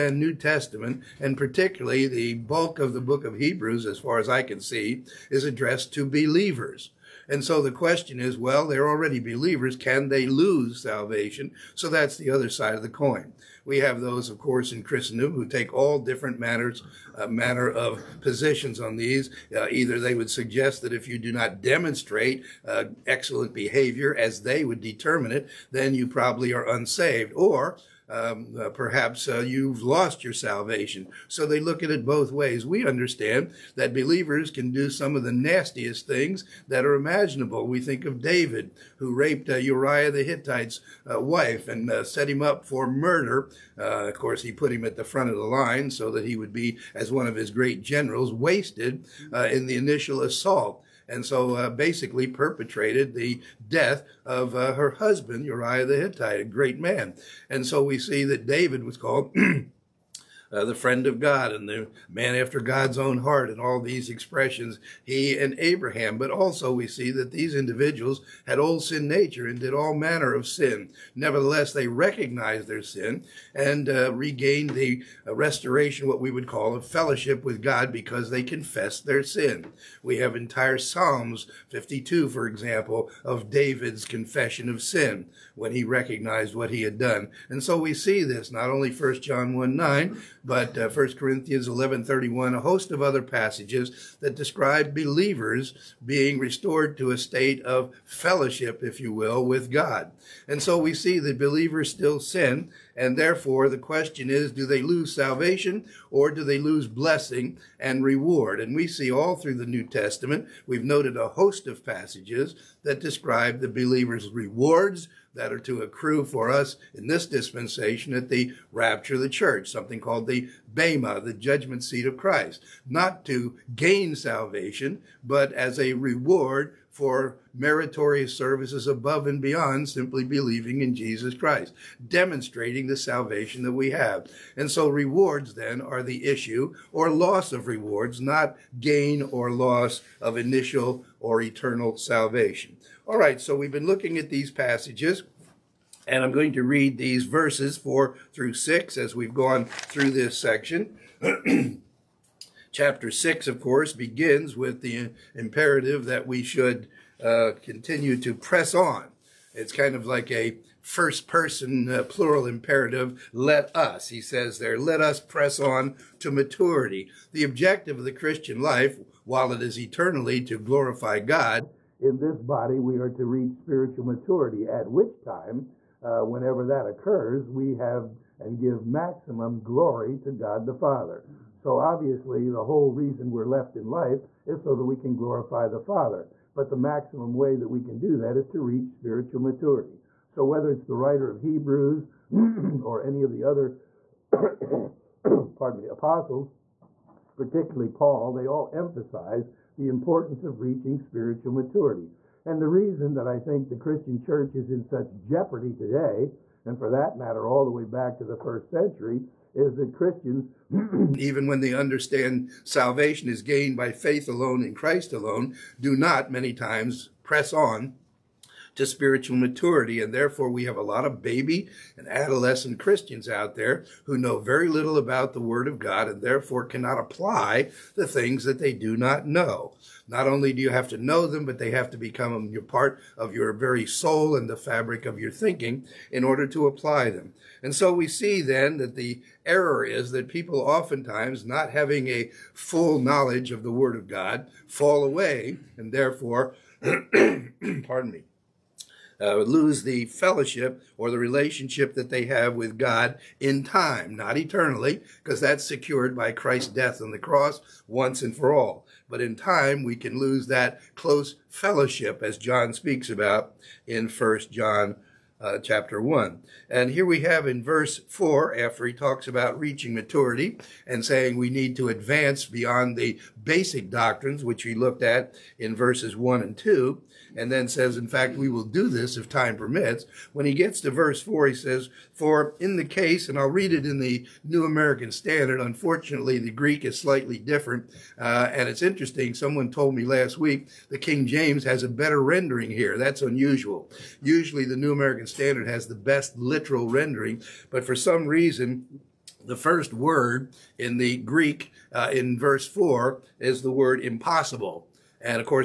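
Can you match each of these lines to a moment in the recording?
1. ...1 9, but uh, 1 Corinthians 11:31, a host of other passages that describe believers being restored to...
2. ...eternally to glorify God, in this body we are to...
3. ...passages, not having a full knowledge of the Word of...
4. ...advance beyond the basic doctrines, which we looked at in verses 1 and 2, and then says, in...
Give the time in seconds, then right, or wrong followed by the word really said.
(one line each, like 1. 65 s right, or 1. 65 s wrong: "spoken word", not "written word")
1. 89 s right
2. 169 s right
3. 240 s wrong: "oftentimes", not "passages"
4. 271 s right.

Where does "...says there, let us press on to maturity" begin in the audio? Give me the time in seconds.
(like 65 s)
164 s.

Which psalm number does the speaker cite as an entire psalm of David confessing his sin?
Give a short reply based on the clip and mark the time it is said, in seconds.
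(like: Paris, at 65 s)
52, at 80 s.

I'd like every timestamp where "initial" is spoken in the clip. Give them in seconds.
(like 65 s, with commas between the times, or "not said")
49 s, 140 s.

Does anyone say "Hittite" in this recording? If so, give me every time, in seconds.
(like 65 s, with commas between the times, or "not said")
40 s, 55 s.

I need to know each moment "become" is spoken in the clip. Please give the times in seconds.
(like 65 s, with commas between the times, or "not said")
231 s.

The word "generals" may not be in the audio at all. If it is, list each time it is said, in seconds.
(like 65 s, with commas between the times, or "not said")
47 s.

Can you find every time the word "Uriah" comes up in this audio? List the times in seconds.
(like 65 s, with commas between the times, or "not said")
39 s, 55 s.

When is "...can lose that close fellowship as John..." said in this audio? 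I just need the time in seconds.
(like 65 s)
259 s.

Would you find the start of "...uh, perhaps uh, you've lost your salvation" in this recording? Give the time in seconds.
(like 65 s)
28 s.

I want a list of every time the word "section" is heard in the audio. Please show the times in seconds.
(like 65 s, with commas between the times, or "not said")
150 s.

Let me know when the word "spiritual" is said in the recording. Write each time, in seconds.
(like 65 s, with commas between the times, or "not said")
173 s, 188 s, 200 s, 218 s.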